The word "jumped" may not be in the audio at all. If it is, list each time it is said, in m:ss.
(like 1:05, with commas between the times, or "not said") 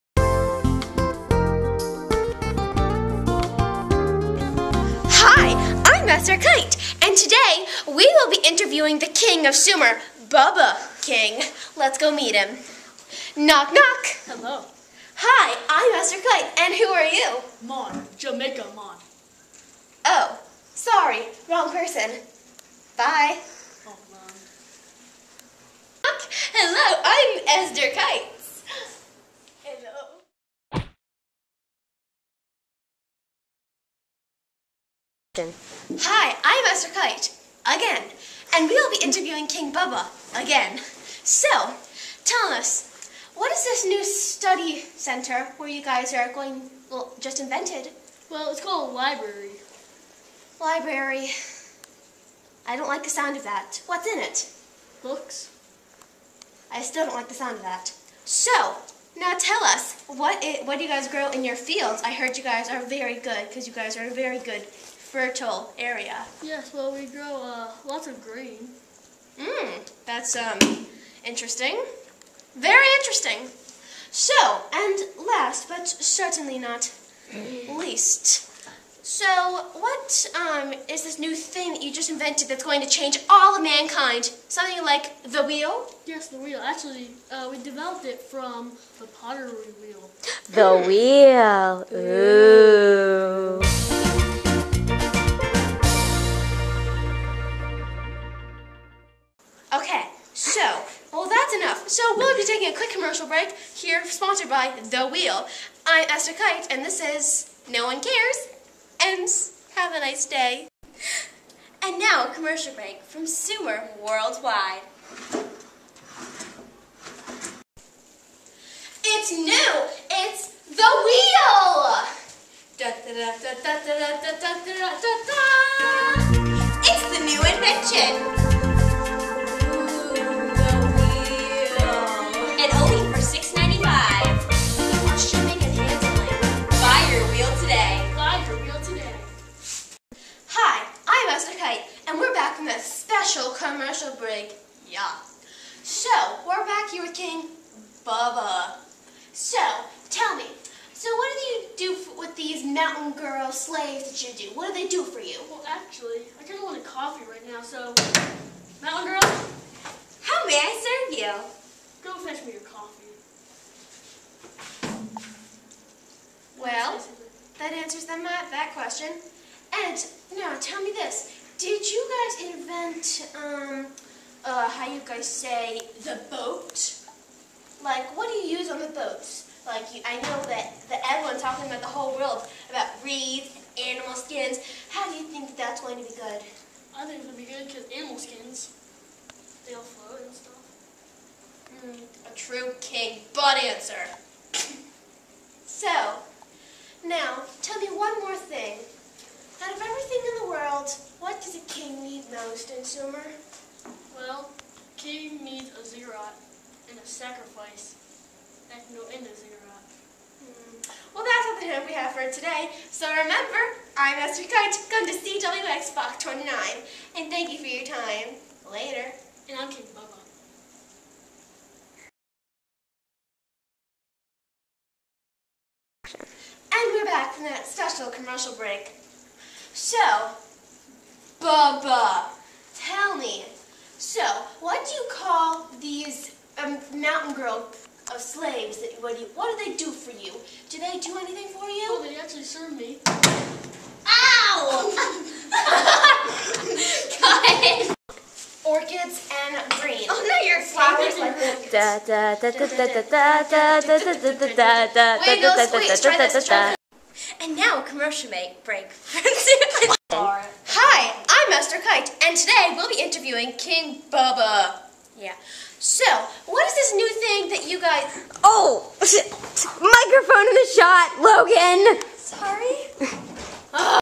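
not said.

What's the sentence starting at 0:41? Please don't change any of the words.
So, tell us, what is this new study center where you guys are going, well, just invented?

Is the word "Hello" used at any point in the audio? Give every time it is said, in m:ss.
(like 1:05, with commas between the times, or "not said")
0:14, 0:26.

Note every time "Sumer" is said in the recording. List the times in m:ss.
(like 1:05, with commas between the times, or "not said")
0:09, 1:53.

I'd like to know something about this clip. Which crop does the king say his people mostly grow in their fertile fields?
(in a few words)
grain.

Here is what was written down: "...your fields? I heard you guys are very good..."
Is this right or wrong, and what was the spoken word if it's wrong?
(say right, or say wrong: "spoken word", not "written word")
right.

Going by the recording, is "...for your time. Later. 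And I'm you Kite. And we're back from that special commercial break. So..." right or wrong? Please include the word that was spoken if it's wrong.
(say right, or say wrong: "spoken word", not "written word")
wrong: "Bubba", not "Kite".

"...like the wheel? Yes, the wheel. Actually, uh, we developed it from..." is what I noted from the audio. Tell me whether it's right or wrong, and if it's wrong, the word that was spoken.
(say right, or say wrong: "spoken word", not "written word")
right.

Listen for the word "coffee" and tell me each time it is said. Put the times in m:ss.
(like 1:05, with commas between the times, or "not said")
2:36, 2:42.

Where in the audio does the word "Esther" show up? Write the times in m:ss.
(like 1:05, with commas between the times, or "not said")
0:27, 0:36, 1:46, 3:34.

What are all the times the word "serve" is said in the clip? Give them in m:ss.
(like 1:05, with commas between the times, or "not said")
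2:40, 4:02.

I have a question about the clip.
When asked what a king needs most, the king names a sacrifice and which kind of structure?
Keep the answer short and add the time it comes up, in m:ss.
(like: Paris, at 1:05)
ziggurat, at 3:25.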